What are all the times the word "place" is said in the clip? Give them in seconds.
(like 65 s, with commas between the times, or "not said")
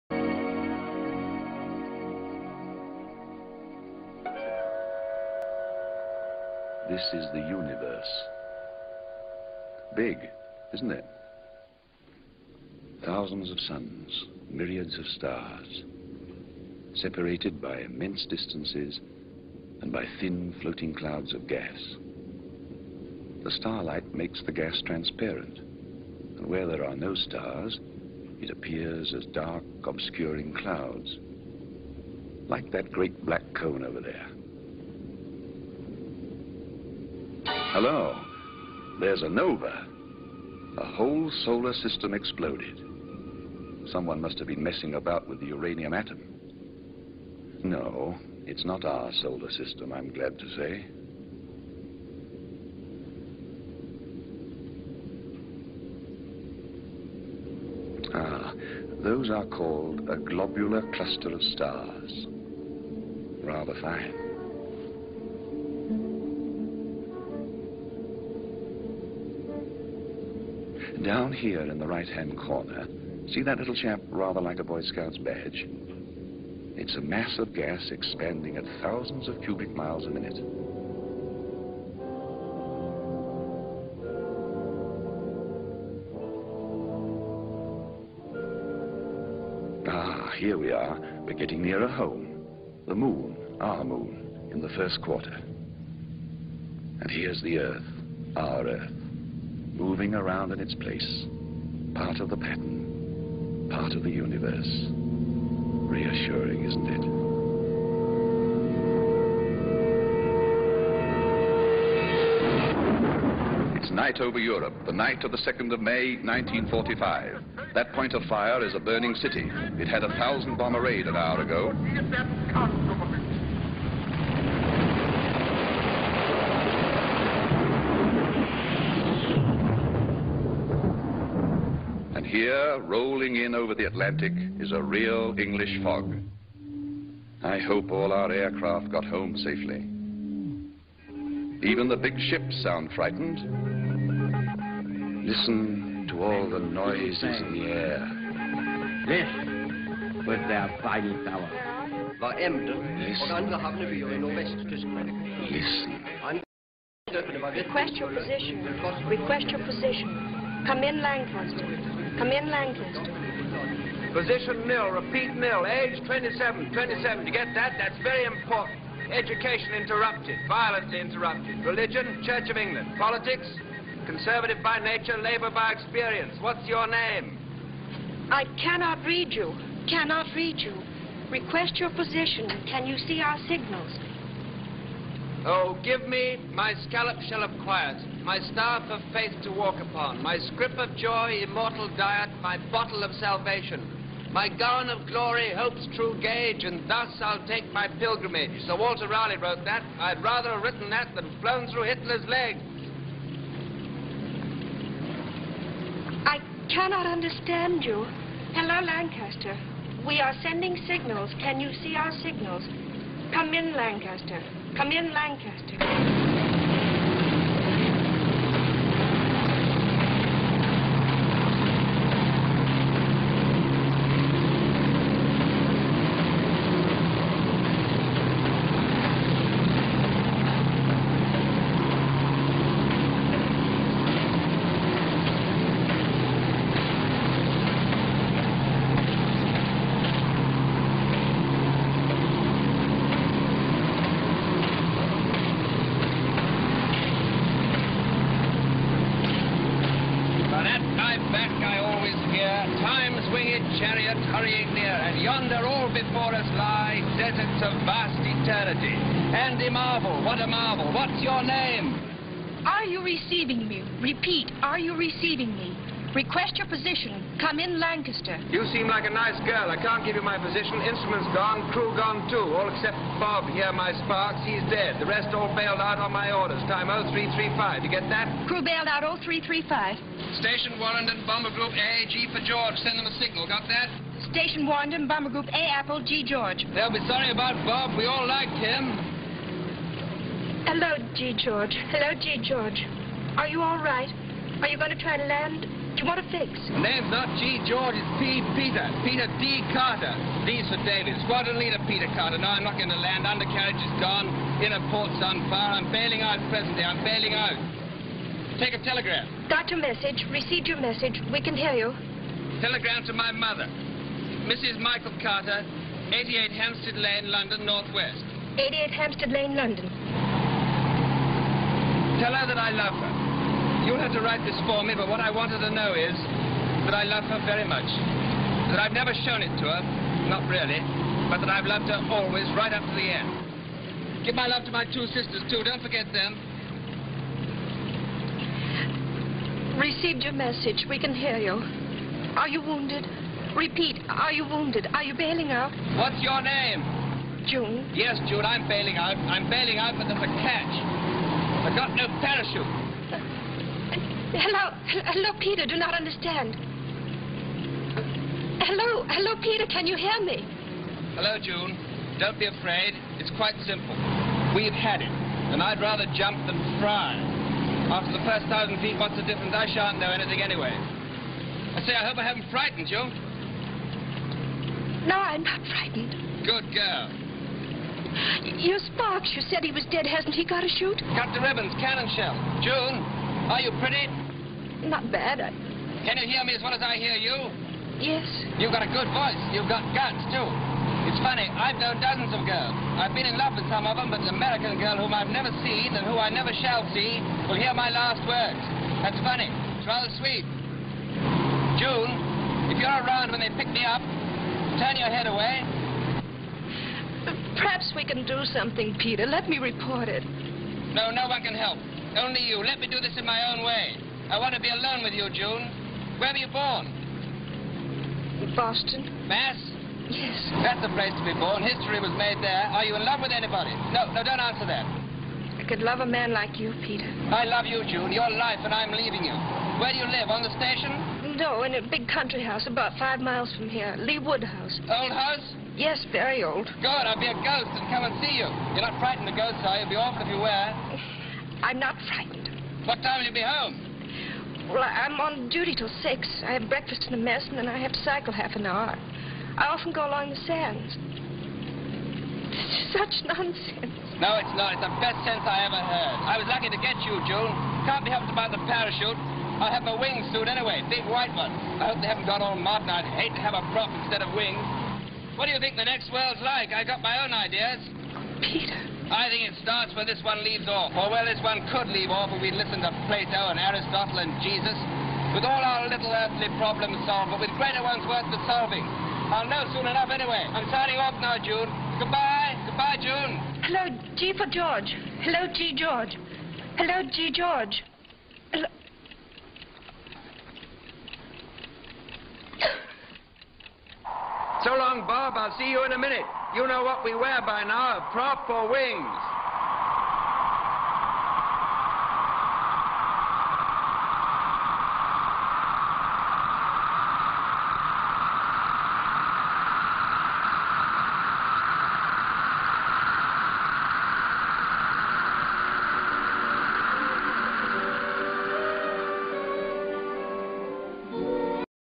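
100 s, 420 s.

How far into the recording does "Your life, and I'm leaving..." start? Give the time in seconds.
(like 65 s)
428 s.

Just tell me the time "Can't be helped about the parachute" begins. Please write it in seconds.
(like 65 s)
457 s.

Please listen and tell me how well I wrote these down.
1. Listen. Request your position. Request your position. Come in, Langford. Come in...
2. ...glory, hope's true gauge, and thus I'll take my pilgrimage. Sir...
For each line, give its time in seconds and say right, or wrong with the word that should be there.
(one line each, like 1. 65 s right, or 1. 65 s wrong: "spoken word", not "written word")
1. 156 s right
2. 195 s right.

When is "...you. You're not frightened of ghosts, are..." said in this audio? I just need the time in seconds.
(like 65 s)
438 s.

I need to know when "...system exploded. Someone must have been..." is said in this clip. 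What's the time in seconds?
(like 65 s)
41 s.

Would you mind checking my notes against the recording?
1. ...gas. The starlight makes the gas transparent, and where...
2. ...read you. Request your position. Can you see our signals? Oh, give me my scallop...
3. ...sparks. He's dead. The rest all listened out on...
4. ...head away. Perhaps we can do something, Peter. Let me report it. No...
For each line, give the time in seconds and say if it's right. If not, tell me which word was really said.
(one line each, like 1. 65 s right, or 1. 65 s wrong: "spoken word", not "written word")
1. 21 s right
2. 180 s right
3. 274 s wrong: "bailed", not "listened"
4. 405 s right.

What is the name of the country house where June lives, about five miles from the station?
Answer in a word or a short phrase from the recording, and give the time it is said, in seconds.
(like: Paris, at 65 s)
Lee Woodhouse, at 433 s.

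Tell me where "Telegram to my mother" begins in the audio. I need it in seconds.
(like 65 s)
312 s.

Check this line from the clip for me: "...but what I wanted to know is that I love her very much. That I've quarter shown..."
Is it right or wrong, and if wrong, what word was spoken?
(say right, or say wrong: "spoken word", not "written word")
wrong: "never", not "quarter".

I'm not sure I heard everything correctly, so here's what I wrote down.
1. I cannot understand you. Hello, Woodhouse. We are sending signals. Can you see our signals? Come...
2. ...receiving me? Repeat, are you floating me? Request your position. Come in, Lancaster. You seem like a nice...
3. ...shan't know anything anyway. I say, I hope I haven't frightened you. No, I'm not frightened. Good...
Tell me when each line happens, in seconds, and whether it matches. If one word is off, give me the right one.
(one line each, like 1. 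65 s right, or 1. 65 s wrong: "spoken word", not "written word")
1. 206 s wrong: "Lancaster", not "Woodhouse"
2. 263 s wrong: "receiving", not "floating"
3. 369 s right.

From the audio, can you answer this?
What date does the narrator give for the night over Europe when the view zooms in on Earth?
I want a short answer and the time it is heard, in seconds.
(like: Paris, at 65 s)
2nd of May, 1945, at 115 s.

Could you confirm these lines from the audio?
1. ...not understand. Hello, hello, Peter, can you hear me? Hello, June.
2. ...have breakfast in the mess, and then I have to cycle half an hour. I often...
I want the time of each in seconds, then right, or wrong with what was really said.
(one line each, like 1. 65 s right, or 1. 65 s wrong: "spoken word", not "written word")
1. 355 s right
2. 446 s right.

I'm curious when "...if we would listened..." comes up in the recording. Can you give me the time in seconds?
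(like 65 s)
472 s.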